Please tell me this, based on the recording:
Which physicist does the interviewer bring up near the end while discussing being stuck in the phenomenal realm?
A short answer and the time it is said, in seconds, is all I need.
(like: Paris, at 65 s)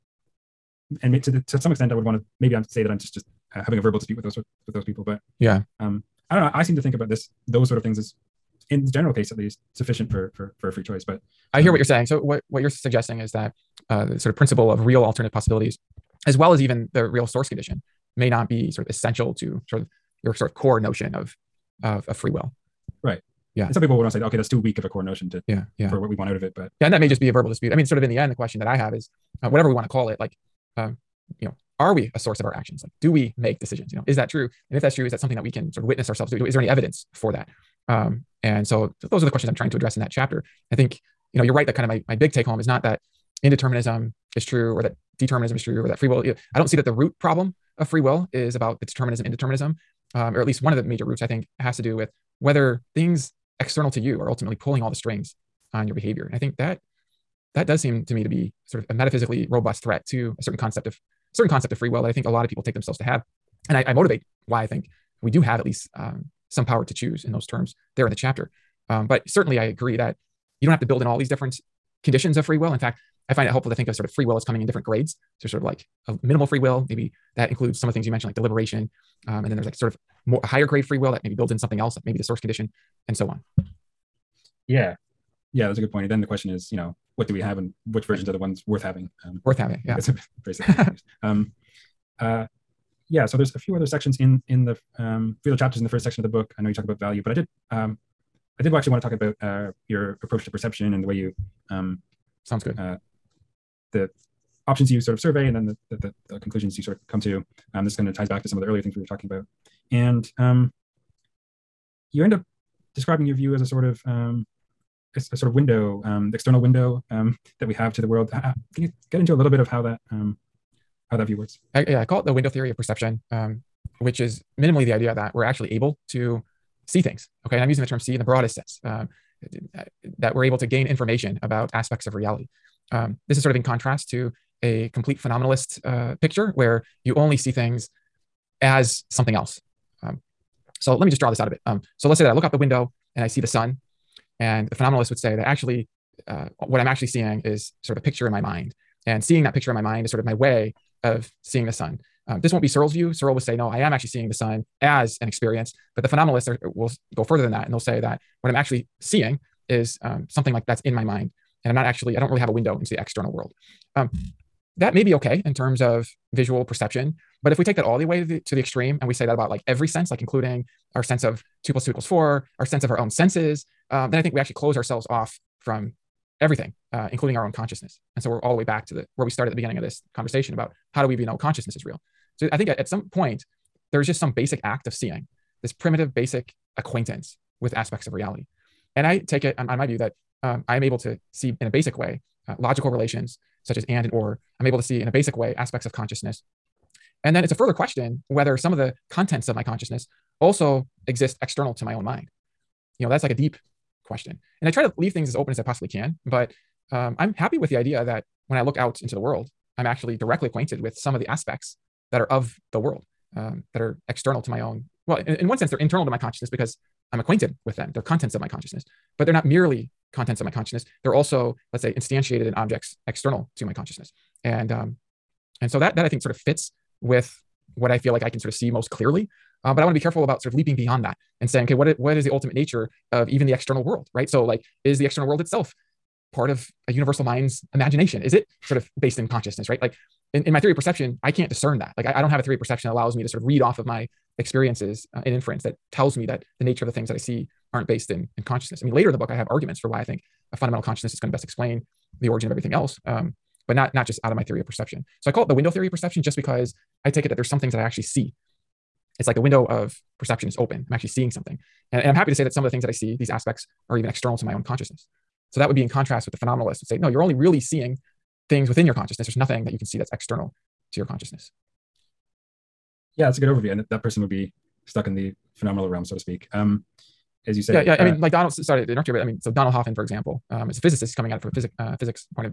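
Donald Hoffman, at 279 s.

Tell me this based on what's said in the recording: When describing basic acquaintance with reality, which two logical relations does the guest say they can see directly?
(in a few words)
and and or.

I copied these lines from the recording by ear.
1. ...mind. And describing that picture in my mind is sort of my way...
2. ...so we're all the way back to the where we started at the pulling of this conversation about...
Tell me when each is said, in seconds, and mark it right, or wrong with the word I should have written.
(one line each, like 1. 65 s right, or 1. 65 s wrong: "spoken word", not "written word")
1. 148 s wrong: "seeing", not "describing"
2. 178 s wrong: "beginning", not "pulling".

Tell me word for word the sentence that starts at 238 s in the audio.
Is it sort of based in consciousness, right?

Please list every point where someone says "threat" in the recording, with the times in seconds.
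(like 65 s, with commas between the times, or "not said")
59 s.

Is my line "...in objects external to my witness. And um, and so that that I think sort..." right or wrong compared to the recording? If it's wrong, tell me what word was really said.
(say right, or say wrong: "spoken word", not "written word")
wrong: "consciousness", not "witness".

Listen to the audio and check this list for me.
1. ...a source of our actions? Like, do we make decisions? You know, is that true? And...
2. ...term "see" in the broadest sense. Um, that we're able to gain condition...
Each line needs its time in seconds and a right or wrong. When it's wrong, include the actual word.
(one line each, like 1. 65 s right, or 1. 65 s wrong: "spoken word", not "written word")
1. 32 s right
2. 127 s wrong: "information", not "condition".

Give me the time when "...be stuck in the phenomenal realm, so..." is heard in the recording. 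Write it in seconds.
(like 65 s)
274 s.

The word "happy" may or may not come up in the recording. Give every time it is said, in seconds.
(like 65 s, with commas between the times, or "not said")
207 s, 262 s.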